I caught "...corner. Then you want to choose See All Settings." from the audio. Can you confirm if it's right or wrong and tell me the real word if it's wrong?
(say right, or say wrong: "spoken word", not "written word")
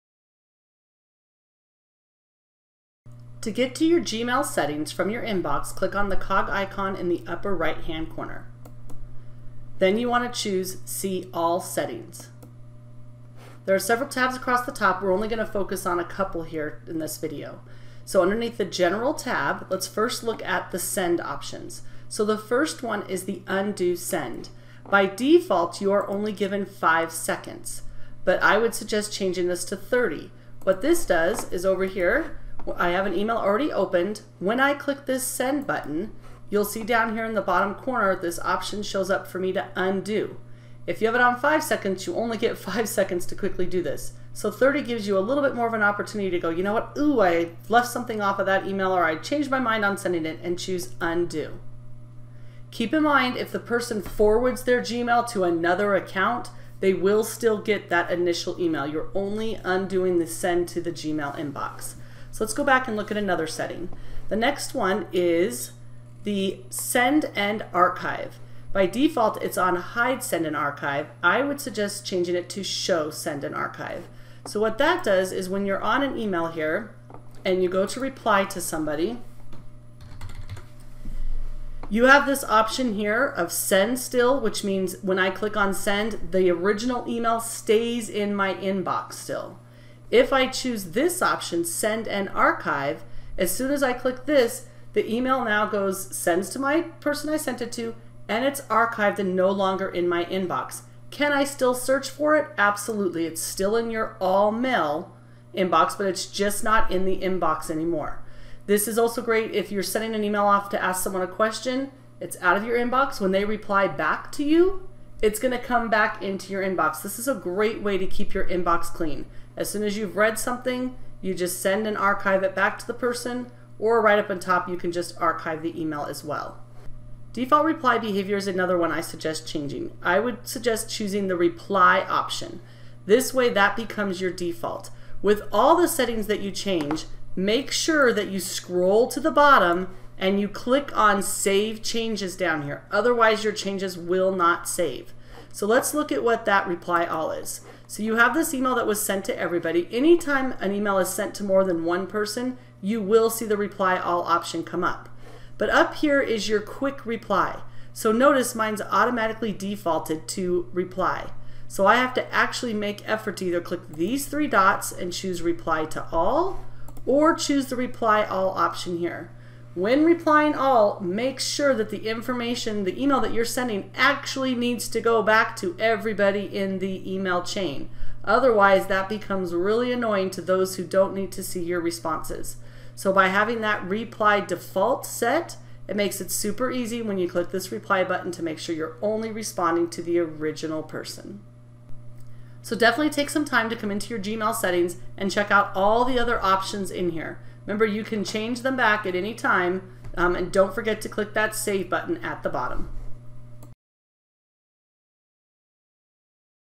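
right.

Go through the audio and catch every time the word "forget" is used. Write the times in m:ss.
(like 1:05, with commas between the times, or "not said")
3:20.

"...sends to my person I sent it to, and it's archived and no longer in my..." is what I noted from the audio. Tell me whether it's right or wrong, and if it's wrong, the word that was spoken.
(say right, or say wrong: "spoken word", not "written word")
right.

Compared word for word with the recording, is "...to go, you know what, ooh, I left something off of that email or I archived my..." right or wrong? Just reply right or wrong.
wrong.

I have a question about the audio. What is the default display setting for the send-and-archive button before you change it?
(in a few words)
hide send and archive.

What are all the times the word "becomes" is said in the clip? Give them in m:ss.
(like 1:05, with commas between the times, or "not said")
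2:13, 2:59.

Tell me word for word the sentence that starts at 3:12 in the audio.
So definitely take some time to come into your Gmail settings and check out all the other options in here.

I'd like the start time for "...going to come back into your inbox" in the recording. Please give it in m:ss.
1:55.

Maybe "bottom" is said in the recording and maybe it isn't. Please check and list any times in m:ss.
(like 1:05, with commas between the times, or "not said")
0:37, 2:19, 3:22.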